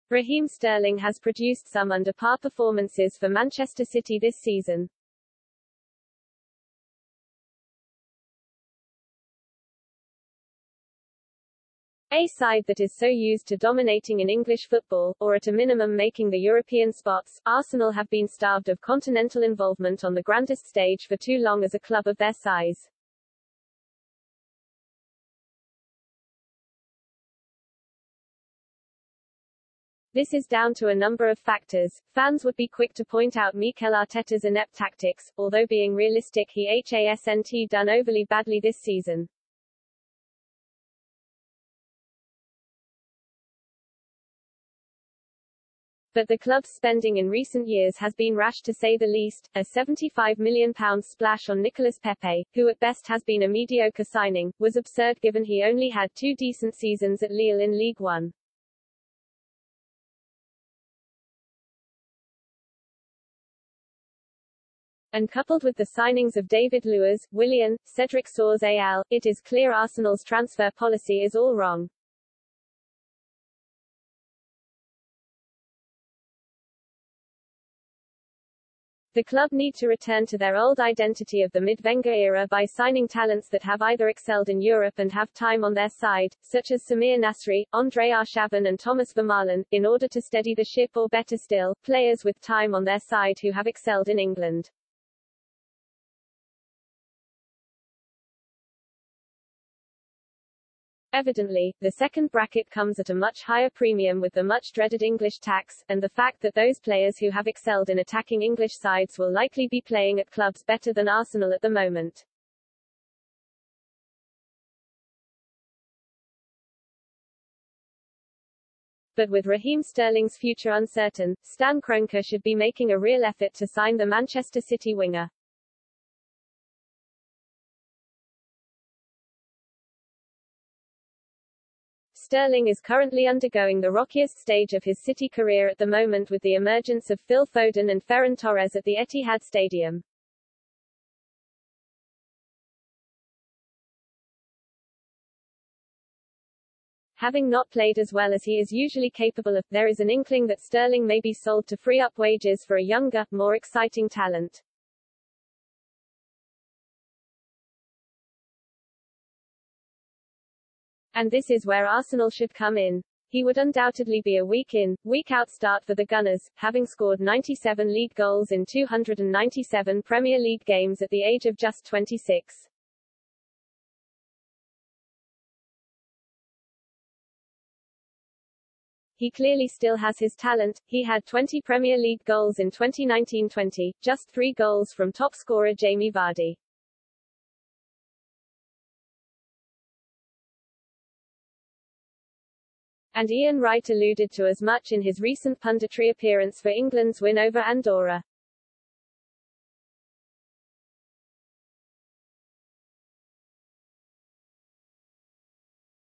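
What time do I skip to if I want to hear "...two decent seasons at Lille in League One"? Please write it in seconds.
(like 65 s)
56 s.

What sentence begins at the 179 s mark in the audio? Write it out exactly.
he clearly still has his talent.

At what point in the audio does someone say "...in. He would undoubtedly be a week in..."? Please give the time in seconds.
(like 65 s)
162 s.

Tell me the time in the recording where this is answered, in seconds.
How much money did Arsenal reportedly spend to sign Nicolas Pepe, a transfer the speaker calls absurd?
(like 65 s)
49 s.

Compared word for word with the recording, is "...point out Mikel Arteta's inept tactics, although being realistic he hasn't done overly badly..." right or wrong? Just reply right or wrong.
right.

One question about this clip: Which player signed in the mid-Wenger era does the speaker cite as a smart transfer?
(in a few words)
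Samir Nasri.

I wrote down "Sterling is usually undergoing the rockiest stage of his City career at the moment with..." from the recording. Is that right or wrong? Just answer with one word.
wrong.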